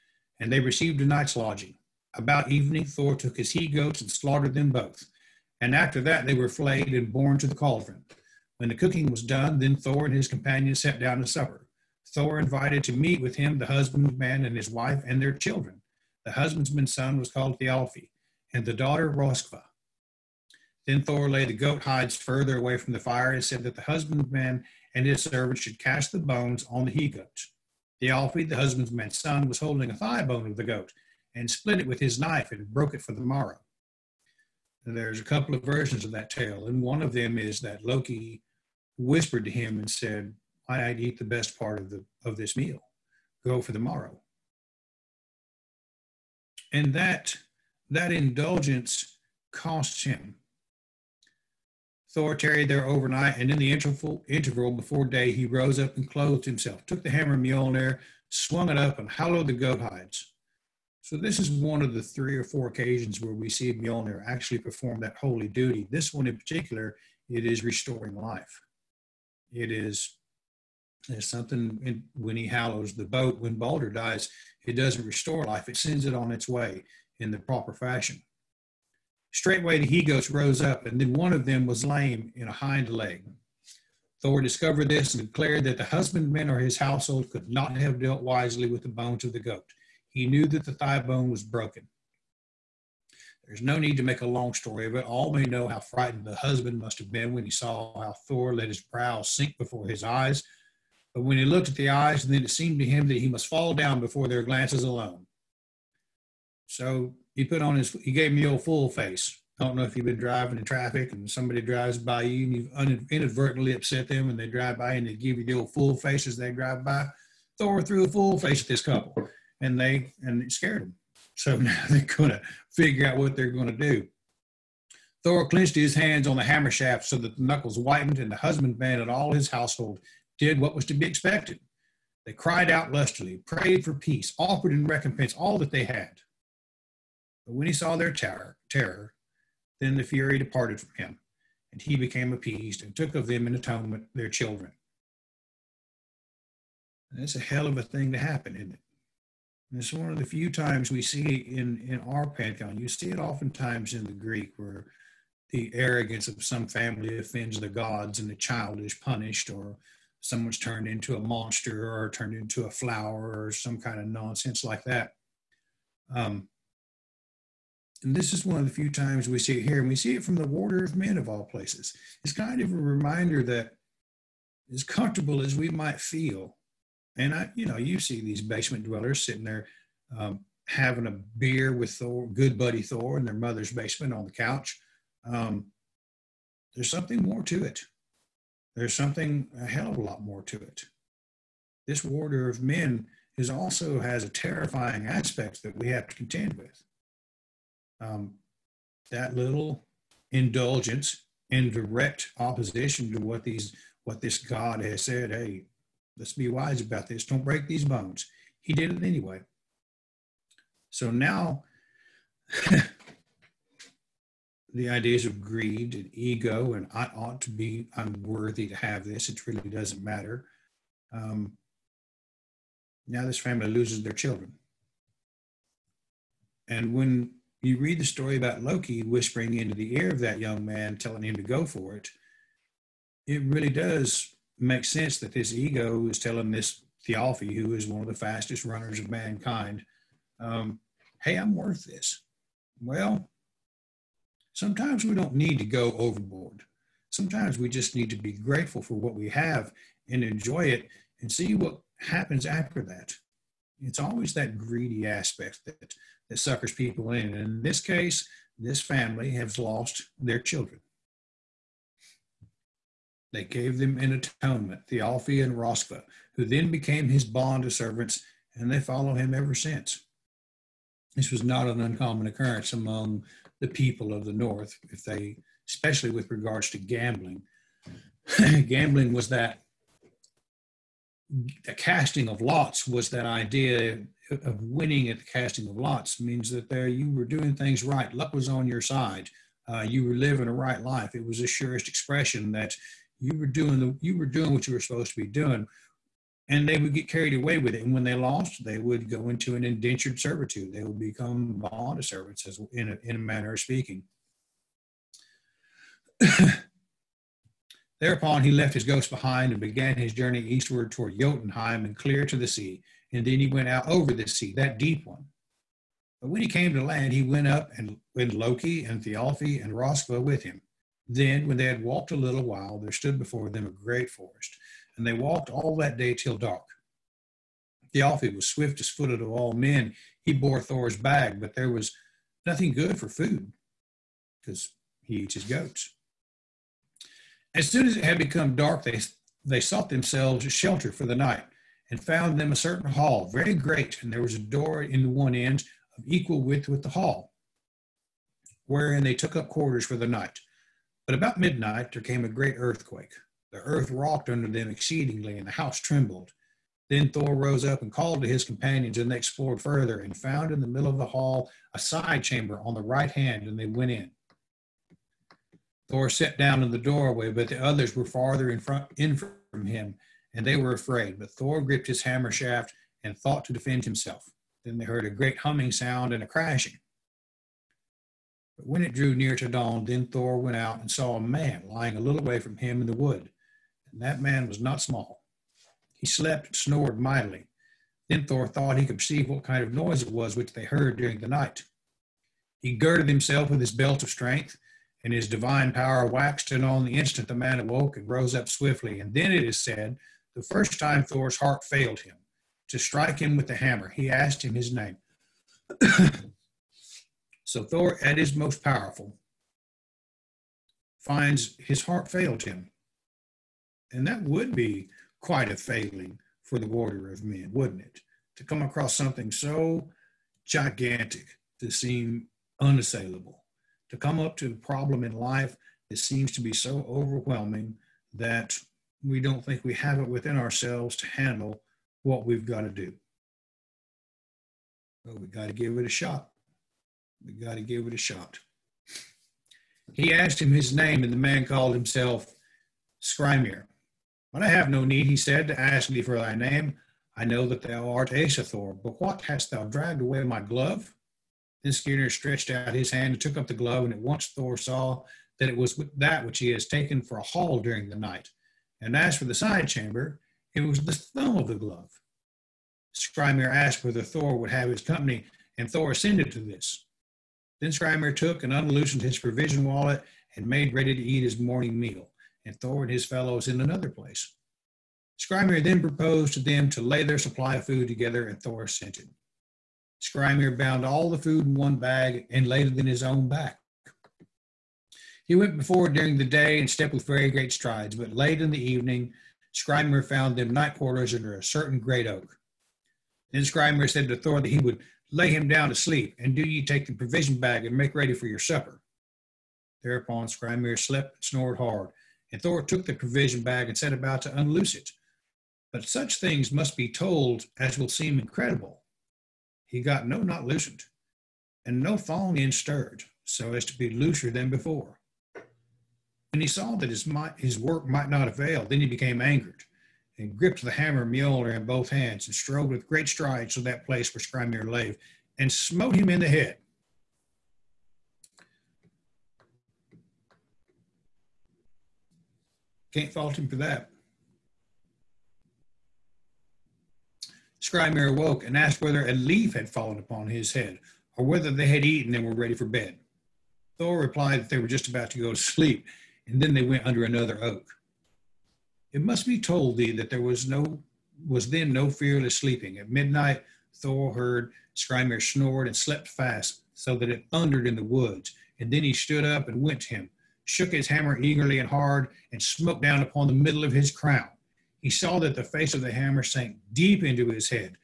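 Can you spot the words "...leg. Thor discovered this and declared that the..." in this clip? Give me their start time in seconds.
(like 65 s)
82 s.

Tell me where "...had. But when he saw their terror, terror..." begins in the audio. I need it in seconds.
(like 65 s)
135 s.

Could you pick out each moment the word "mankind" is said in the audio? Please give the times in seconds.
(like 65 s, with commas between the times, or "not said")
239 s.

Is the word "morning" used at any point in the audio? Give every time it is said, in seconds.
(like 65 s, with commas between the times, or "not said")
471 s.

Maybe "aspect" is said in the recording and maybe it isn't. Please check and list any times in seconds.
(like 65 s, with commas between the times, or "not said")
195 s, 255 s.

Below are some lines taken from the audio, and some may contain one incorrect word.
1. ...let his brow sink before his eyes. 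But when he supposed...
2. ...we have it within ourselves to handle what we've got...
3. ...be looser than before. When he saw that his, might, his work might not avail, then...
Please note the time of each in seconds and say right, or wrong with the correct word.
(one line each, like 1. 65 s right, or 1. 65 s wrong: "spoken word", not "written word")
1. 98 s wrong: "looked", not "supposed"
2. 429 s right
3. 513 s right.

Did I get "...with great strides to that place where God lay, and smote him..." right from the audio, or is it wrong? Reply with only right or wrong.
wrong.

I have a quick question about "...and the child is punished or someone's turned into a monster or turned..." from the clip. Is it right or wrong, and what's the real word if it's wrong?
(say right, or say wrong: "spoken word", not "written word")
right.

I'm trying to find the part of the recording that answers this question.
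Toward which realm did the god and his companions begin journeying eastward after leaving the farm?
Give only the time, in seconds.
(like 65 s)
311 s.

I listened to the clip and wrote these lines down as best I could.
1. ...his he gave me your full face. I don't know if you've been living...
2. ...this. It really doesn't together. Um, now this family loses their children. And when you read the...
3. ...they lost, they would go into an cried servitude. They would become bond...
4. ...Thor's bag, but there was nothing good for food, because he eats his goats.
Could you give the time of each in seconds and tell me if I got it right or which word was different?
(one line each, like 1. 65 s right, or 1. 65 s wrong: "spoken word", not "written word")
1. 107 s wrong: "driving", not "living"
2. 219 s wrong: "matter", not "together"
3. 298 s wrong: "indentured", not "cried"
4. 330 s right.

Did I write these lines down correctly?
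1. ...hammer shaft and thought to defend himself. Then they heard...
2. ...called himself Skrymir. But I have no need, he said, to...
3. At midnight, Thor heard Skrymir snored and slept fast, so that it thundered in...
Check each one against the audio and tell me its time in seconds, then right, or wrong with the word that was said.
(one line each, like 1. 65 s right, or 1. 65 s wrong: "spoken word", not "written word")
1. 372 s right
2. 441 s right
3. 552 s right.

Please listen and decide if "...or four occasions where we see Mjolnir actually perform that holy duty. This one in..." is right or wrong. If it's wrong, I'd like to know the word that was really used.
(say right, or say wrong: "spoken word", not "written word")
right.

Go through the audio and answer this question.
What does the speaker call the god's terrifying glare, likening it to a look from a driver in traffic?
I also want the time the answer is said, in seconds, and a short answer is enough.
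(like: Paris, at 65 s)
The old full face, at 115 s.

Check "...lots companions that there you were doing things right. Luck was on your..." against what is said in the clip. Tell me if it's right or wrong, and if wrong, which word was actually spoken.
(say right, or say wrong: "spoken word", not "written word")
wrong: "means", not "companions".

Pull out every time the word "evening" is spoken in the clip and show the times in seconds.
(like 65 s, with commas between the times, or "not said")
2 s, 488 s.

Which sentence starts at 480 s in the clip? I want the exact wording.
Skrymir bound all the food in one bag and laid it in his own back.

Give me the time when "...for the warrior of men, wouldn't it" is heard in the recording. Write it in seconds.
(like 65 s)
416 s.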